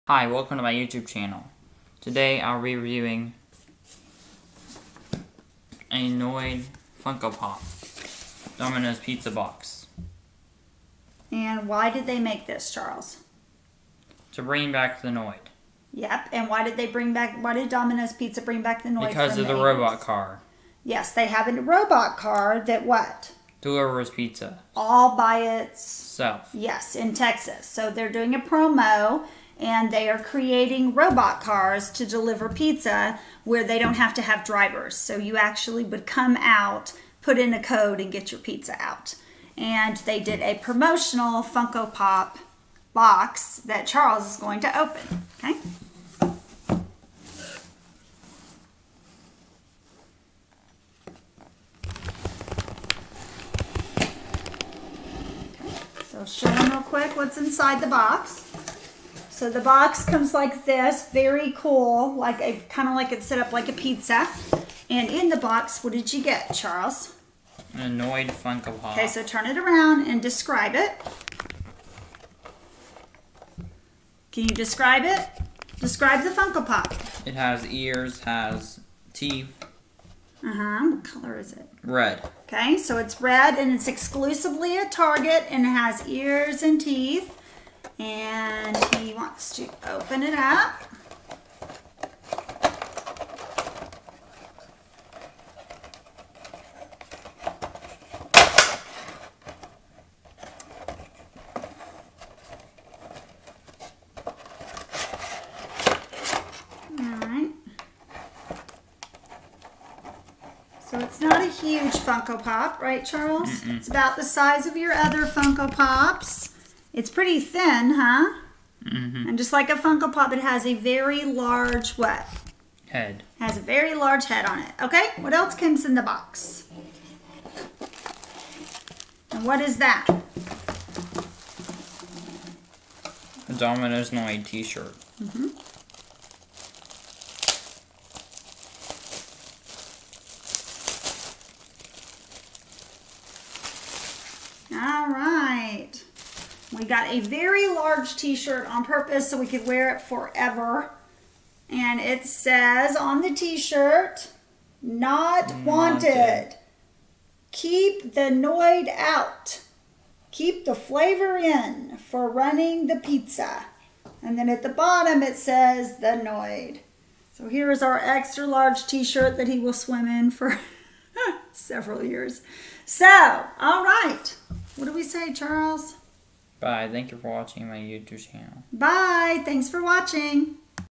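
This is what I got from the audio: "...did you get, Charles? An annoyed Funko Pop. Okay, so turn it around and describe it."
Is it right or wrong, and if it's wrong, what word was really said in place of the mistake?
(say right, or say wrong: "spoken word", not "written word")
right.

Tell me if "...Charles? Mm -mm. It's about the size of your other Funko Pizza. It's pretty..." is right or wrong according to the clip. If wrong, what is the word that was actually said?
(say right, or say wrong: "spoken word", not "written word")
wrong: "Pops", not "Pizza".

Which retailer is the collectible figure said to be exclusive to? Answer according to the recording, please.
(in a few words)
Target.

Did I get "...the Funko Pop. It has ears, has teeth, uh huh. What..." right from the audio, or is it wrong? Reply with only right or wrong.
right.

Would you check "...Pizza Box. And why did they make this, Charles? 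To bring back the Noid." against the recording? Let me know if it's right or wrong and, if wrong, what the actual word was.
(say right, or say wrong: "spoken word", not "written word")
right.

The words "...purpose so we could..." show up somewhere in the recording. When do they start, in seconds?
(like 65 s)
148 s.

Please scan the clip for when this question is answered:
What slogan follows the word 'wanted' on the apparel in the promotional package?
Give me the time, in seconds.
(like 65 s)
157 s.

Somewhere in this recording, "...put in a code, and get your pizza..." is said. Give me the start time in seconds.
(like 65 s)
37 s.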